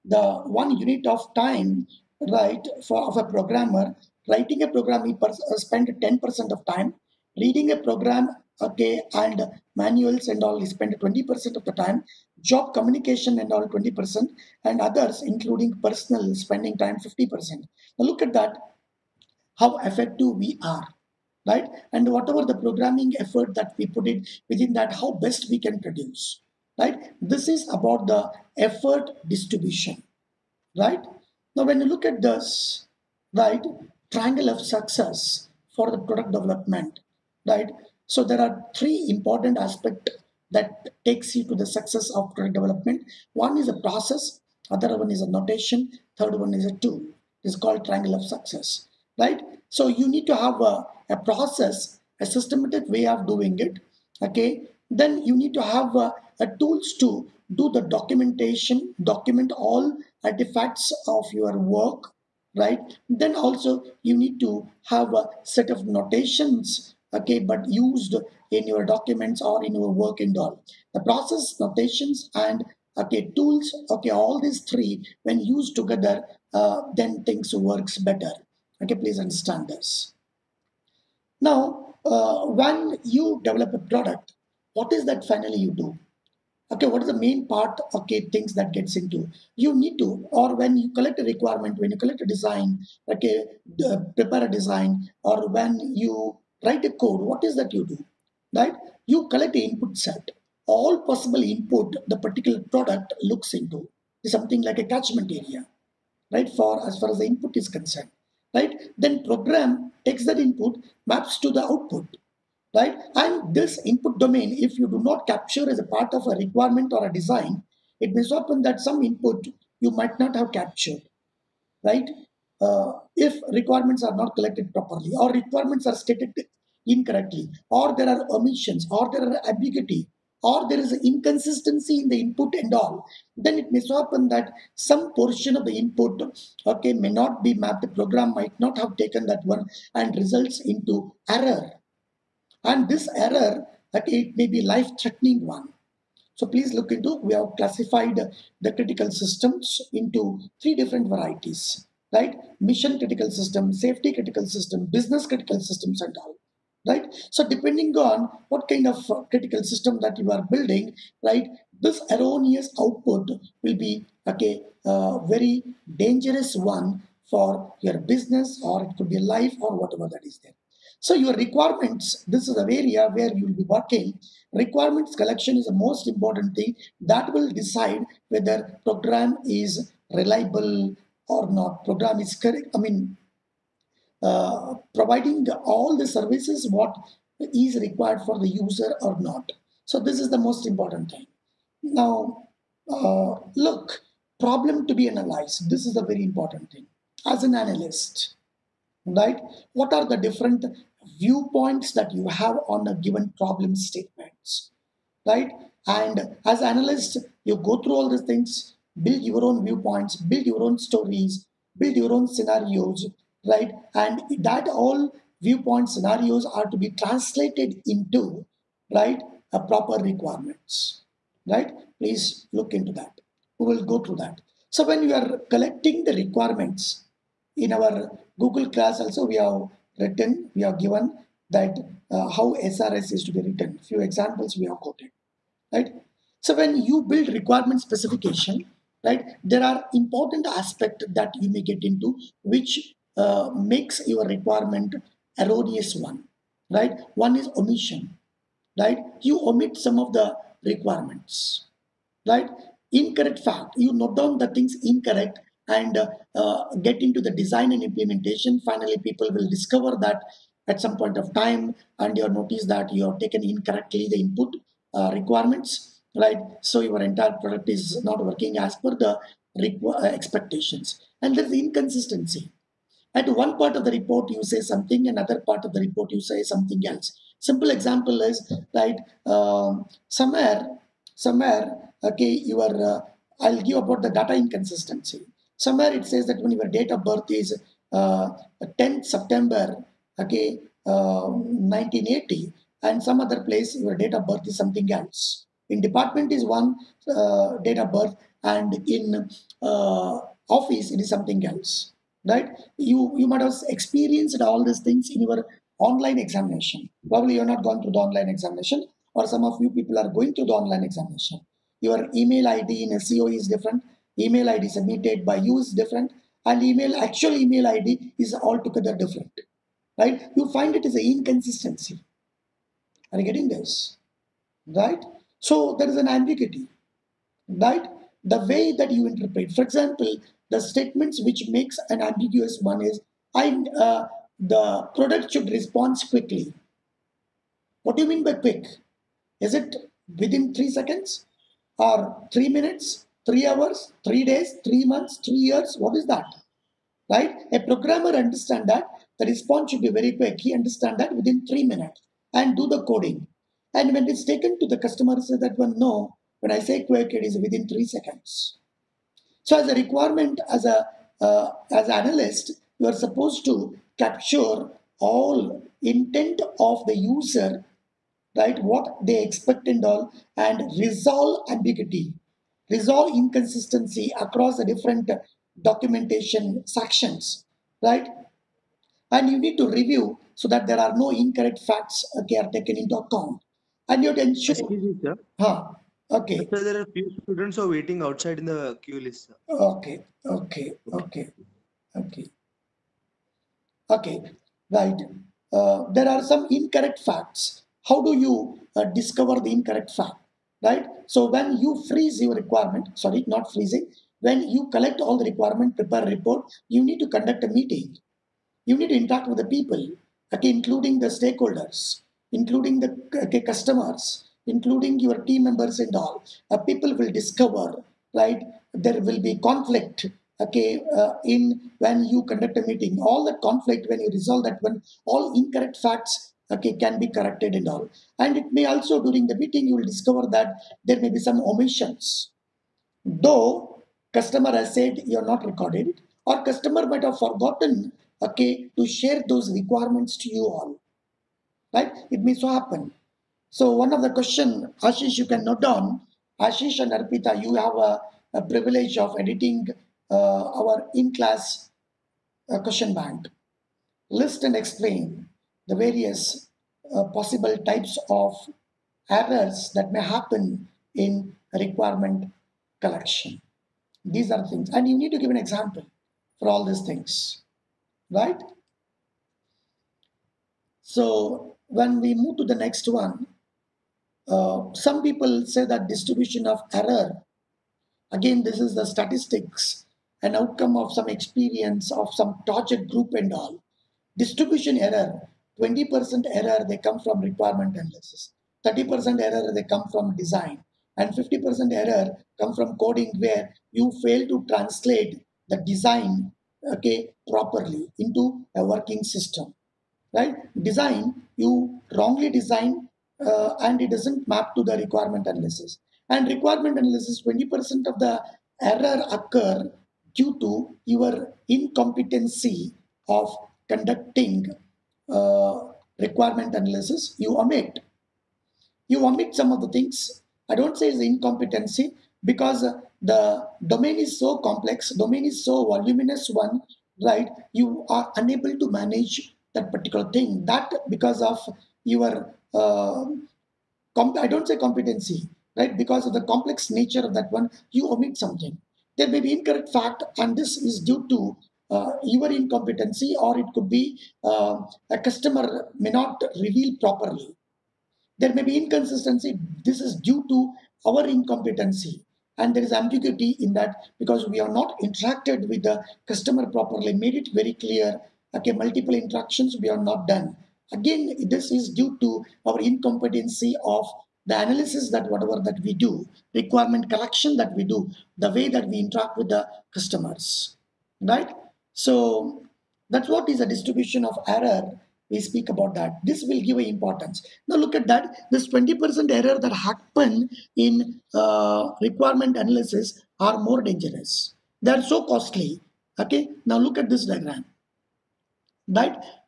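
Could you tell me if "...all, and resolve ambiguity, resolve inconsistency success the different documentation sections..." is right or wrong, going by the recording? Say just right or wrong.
wrong.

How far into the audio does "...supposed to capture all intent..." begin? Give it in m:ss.
6:02.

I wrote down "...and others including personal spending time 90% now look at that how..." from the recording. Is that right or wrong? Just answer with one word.
wrong.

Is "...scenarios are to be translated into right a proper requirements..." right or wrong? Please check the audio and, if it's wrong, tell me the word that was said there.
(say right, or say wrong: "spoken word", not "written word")
right.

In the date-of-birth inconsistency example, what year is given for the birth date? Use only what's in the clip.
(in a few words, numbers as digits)
1980.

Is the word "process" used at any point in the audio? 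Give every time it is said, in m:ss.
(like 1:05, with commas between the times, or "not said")
0:43, 0:51, 1:11.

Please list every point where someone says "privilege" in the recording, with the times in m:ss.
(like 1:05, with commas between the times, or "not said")
7:28.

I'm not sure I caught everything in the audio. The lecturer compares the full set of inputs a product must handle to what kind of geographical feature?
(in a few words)
Catchment area.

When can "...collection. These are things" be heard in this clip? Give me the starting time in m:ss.
7:42.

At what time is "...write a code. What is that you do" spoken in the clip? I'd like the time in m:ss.
1:36.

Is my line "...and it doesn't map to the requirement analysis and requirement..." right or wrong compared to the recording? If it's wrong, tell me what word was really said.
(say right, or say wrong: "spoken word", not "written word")
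right.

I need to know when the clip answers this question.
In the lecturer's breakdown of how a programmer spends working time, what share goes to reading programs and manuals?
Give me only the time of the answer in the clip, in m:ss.
0:06.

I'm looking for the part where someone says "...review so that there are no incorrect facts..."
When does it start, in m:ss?
6:19.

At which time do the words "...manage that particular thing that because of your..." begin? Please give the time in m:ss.
8:48.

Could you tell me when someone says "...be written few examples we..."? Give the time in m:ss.
3:53.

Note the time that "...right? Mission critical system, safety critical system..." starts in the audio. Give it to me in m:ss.
2:32.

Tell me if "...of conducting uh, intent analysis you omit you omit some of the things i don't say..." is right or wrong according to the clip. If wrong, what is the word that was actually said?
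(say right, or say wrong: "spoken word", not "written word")
wrong: "requirement", not "intent".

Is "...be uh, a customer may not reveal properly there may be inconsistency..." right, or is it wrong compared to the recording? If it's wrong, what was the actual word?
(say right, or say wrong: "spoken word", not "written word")
right.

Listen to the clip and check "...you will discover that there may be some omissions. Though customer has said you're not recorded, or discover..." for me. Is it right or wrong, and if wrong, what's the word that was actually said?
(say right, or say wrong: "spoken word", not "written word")
wrong: "customer", not "discover".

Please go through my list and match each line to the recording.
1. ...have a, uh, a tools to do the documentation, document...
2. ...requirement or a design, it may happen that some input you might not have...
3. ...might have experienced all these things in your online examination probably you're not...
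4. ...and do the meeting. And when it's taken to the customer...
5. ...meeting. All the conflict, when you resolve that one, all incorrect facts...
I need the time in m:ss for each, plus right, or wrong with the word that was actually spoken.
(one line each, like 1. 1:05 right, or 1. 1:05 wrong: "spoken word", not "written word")
1. 0:55 right
2. 1:56 right
3. 5:03 right
4. 5:52 wrong: "coding", not "meeting"
5. 7:02 right.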